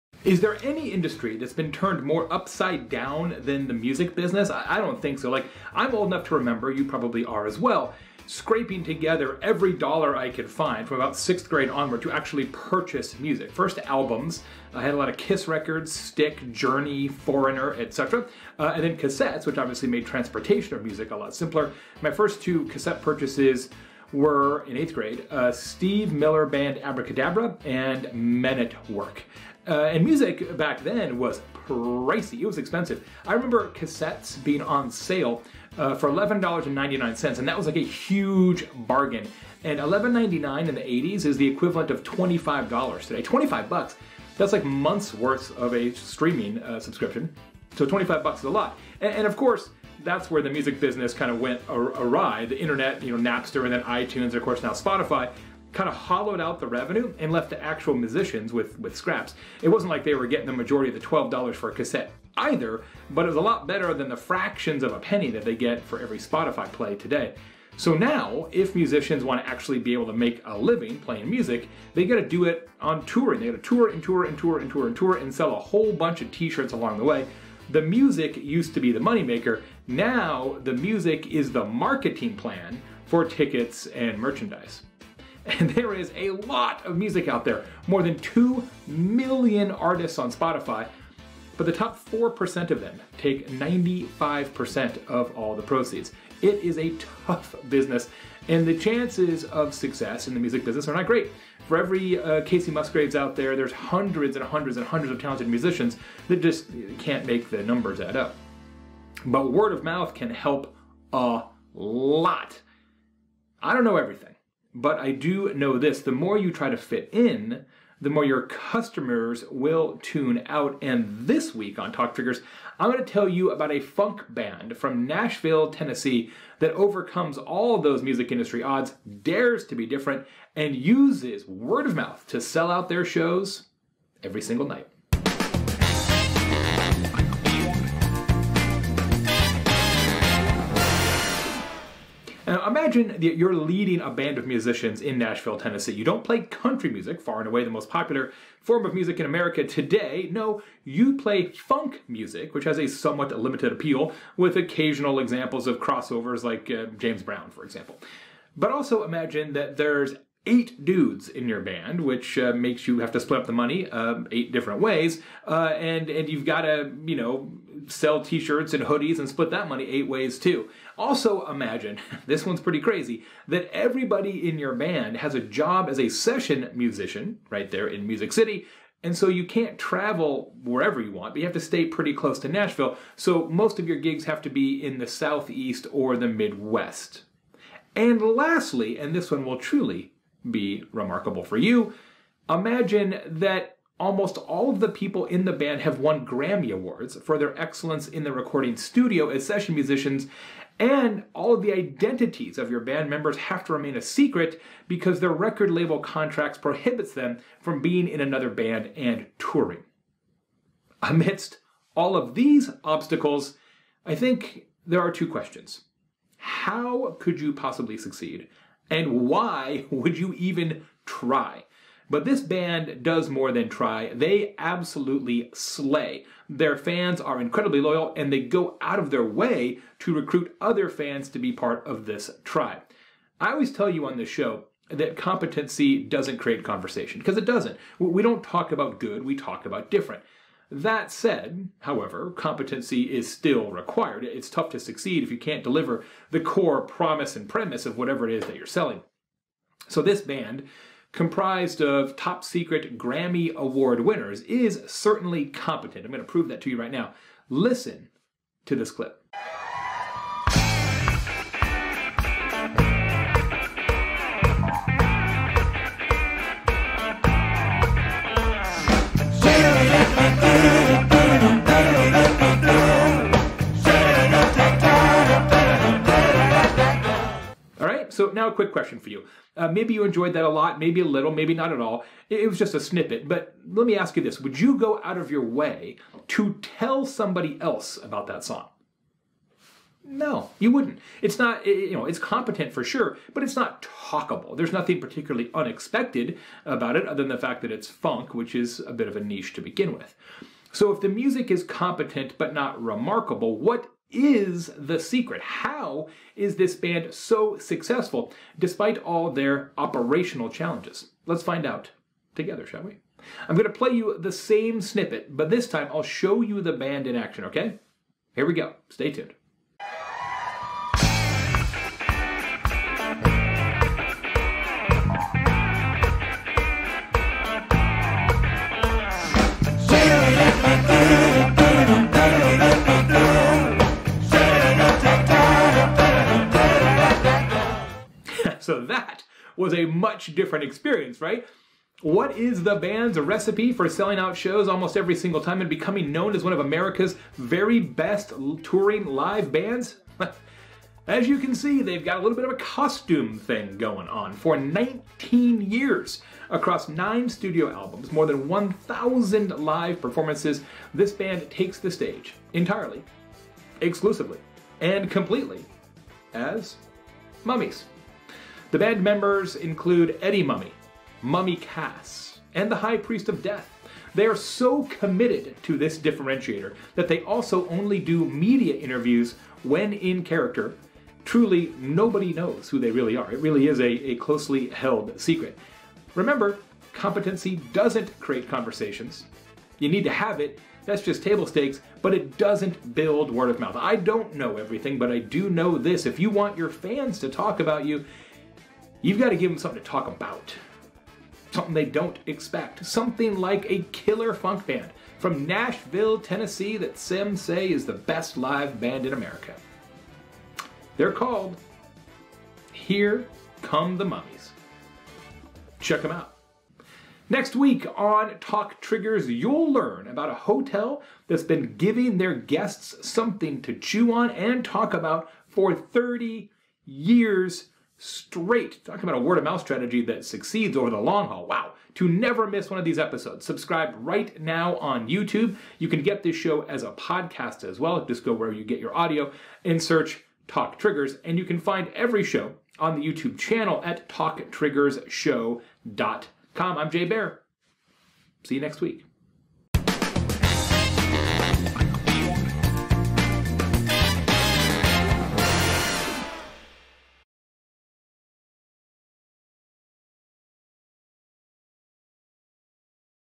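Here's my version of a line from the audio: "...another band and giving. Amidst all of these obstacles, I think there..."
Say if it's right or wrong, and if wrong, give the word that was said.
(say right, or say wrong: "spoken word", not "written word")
wrong: "touring", not "giving".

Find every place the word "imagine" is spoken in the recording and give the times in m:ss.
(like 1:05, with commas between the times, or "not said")
2:22, 2:39, 2:51, 3:12.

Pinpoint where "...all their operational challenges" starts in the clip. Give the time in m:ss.
5:08.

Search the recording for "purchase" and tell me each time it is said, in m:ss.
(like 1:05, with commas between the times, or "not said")
0:12, 0:23.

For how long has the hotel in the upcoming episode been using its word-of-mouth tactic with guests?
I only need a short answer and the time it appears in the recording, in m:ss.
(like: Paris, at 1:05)
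30 years, at 7:05.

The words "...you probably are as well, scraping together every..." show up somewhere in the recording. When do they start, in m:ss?
0:06.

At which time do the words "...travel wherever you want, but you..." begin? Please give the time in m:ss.
2:59.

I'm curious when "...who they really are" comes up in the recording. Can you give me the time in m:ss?
6:22.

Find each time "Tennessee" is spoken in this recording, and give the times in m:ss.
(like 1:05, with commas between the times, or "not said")
2:05, 2:25, 6:46.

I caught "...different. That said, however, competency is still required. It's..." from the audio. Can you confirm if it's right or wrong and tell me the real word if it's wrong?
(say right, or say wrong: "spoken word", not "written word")
right.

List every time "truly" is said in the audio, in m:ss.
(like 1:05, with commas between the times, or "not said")
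3:09, 6:21.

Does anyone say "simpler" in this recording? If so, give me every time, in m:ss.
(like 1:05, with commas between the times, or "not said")
0:21.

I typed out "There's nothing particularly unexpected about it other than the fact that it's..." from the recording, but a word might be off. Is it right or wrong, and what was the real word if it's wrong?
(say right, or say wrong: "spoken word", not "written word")
right.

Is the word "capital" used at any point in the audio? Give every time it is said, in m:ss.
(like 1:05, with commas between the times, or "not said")
not said.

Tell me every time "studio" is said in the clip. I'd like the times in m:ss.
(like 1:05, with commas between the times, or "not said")
3:18, 5:57.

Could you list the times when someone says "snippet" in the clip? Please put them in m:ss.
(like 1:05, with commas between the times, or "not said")
4:42, 5:14.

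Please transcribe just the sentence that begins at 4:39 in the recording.
Uh, maybe you enjoyed that a lot, maybe a little, maybe not at all.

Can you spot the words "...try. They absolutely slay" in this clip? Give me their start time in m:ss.
3:43.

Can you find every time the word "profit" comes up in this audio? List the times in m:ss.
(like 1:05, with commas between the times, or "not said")
not said.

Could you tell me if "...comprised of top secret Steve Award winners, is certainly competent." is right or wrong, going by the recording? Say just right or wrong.
wrong.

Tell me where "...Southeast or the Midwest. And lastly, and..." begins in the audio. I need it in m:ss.
3:05.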